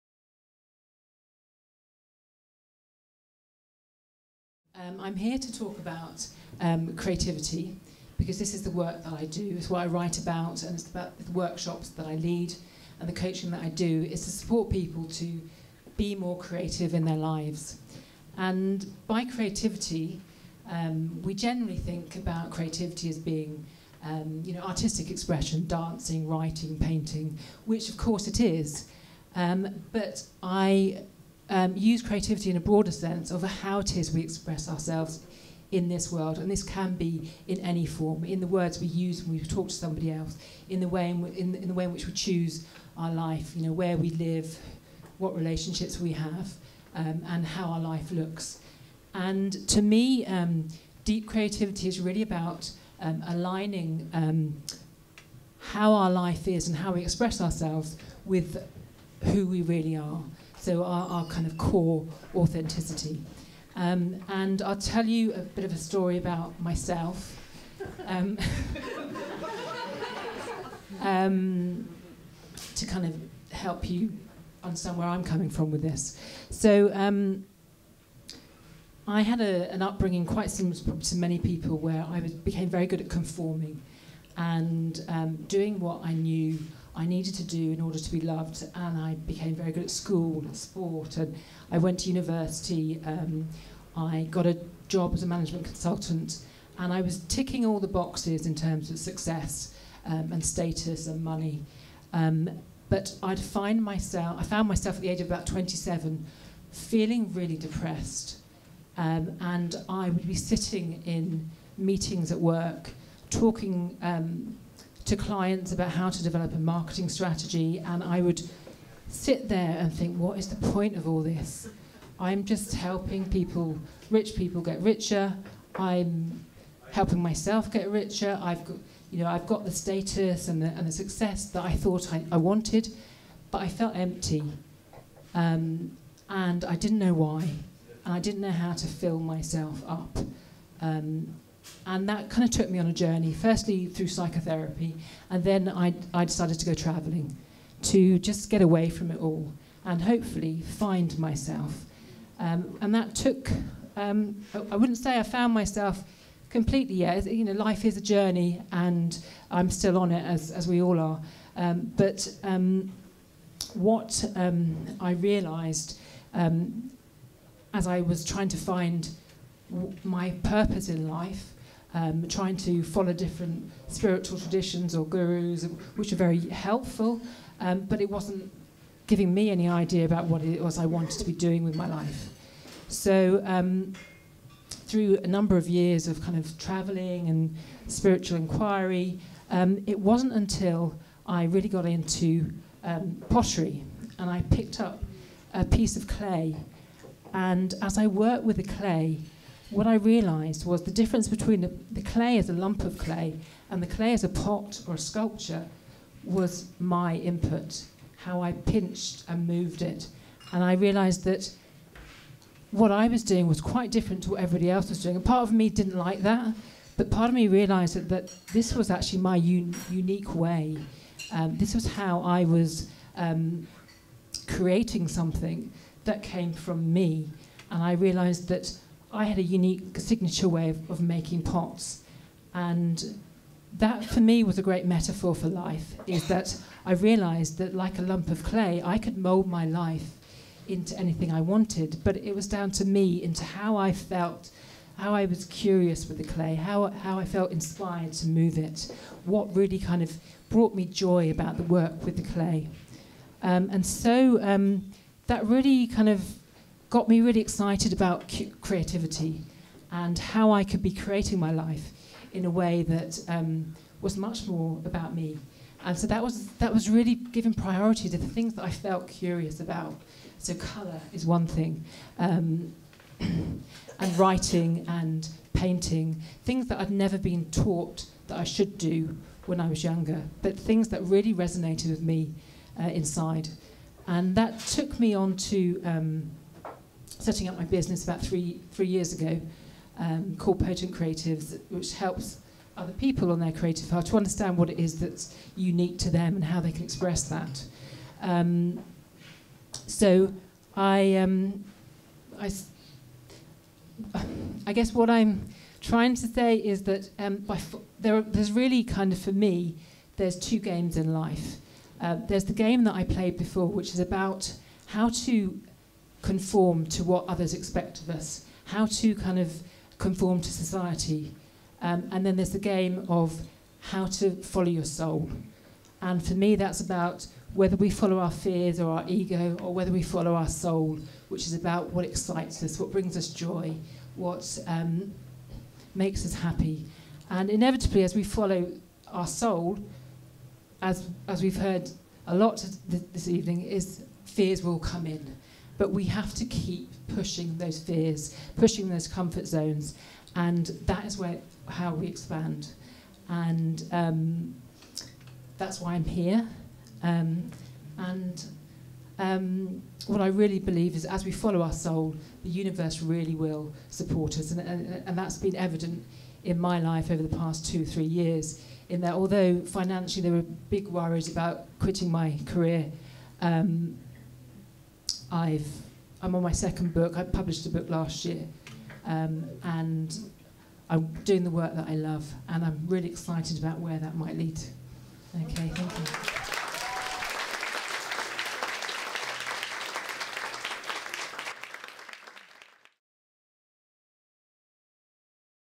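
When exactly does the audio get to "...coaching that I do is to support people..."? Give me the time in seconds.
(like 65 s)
13 s.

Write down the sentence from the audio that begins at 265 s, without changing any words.
And so that was, that was really giving priority to the things that I felt curious about.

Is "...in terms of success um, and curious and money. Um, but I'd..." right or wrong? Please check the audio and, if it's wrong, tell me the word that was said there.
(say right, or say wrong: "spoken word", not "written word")
wrong: "status", not "curious".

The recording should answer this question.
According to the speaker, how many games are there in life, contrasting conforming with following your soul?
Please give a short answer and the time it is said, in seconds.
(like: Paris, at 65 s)
2, at 310 s.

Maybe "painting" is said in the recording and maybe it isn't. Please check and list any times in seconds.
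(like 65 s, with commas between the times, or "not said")
26 s, 275 s.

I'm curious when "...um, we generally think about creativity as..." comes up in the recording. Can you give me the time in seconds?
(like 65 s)
20 s.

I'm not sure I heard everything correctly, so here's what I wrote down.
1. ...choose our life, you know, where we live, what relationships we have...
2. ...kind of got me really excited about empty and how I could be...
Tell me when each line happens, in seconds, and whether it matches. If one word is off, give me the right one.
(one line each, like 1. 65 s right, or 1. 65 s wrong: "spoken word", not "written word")
1. 42 s right
2. 255 s wrong: "creativity", not "empty".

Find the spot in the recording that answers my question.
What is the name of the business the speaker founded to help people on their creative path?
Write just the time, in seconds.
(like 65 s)
290 s.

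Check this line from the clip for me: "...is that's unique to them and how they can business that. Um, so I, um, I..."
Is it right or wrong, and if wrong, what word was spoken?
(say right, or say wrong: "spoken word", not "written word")
wrong: "express", not "business".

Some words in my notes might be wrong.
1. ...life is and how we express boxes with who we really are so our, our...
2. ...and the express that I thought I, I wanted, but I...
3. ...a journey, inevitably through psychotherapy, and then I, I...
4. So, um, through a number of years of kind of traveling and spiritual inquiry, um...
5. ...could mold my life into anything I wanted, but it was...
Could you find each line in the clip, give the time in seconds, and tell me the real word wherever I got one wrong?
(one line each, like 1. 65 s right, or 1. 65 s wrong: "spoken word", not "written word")
1. 56 s wrong: "ourselves", not "boxes"
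2. 130 s wrong: "success", not "express"
3. 142 s wrong: "firstly", not "inevitably"
4. 182 s right
5. 238 s right.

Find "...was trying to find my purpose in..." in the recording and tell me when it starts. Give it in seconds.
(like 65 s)
168 s.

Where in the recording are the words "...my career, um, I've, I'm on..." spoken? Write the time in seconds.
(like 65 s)
372 s.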